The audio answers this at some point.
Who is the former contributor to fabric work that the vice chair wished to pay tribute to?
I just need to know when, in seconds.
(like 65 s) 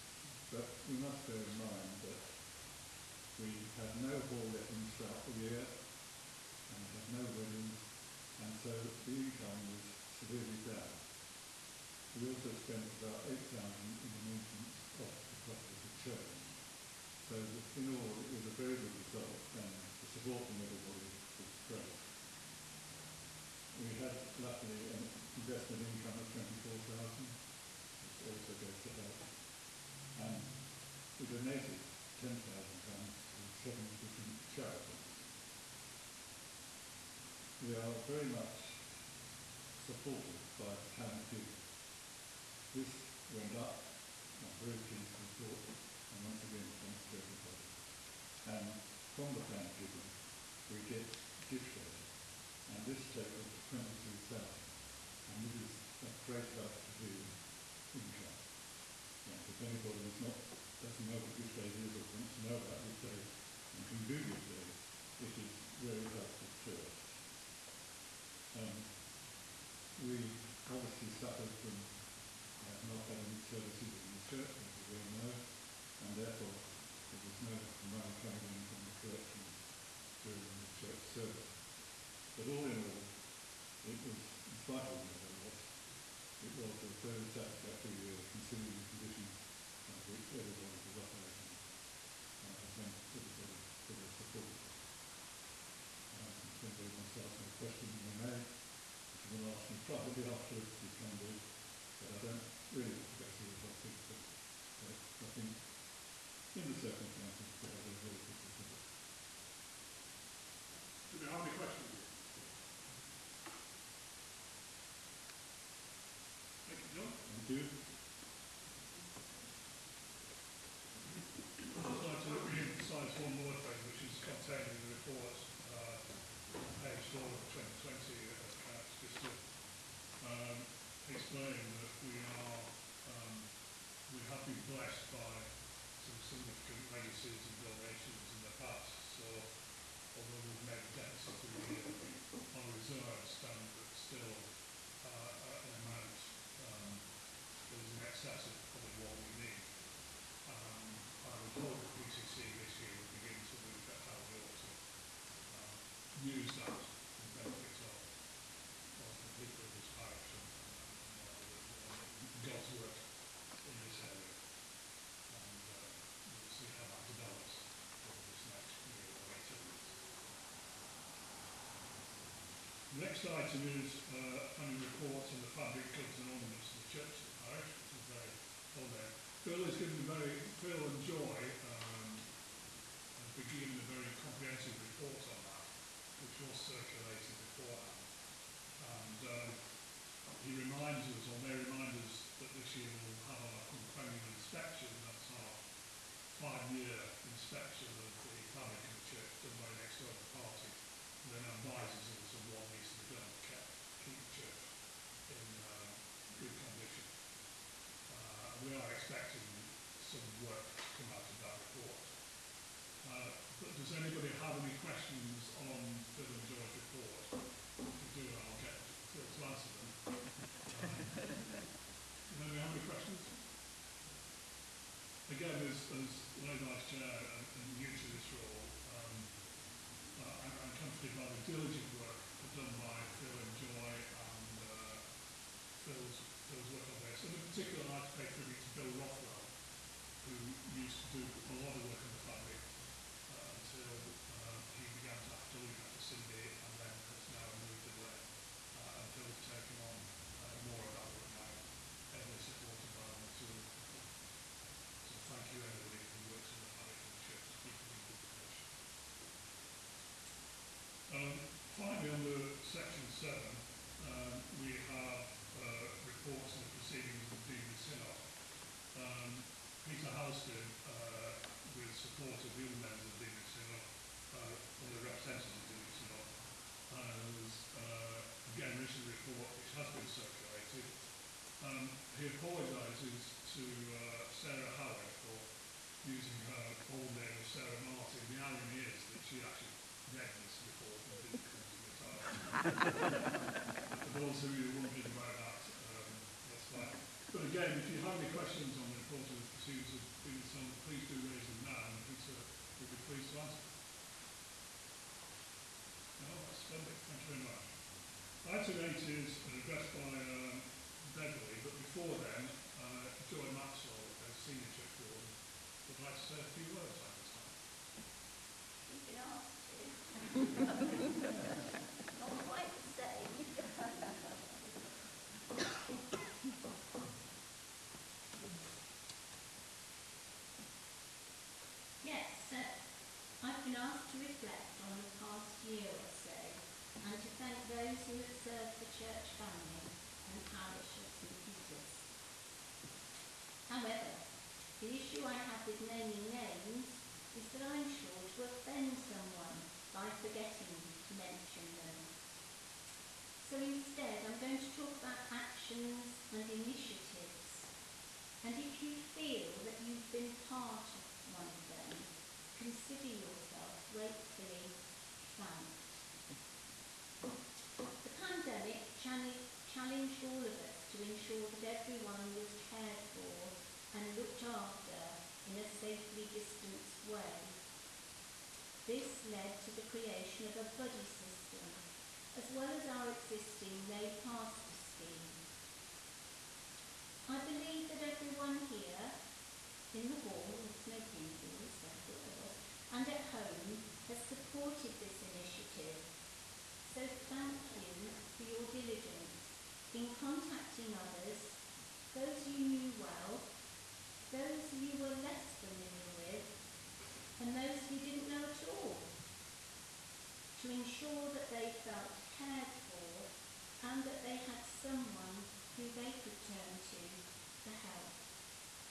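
238 s.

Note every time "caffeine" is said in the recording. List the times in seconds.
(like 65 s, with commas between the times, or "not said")
not said.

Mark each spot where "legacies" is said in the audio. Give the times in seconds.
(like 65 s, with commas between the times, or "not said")
137 s.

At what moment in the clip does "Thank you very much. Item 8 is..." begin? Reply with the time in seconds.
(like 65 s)
307 s.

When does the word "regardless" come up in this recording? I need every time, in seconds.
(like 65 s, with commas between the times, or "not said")
not said.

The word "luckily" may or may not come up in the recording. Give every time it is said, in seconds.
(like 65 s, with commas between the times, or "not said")
24 s.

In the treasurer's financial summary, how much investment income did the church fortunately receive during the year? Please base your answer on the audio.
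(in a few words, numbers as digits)
24,000.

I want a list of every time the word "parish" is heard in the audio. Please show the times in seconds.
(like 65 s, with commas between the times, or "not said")
177 s, 340 s.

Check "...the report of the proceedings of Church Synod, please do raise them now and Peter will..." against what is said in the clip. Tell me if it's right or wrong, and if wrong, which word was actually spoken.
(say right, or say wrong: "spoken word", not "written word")
wrong: "Deanery", not "Church".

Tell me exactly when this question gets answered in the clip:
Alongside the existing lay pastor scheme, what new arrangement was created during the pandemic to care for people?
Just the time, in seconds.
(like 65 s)
380 s.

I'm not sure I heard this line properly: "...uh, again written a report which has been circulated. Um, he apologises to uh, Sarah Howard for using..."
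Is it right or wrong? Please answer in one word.
right.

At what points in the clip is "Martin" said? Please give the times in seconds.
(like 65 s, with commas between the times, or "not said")
287 s.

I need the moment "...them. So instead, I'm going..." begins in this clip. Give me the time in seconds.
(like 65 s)
351 s.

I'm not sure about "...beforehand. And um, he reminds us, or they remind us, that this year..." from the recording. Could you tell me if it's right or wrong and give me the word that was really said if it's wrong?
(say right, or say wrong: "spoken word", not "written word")
right.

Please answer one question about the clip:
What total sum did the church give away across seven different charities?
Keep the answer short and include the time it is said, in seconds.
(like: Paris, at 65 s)
£10,000, at 32 s.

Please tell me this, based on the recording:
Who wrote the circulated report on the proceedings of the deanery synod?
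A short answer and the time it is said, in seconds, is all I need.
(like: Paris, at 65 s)
Peter Halstead, at 269 s.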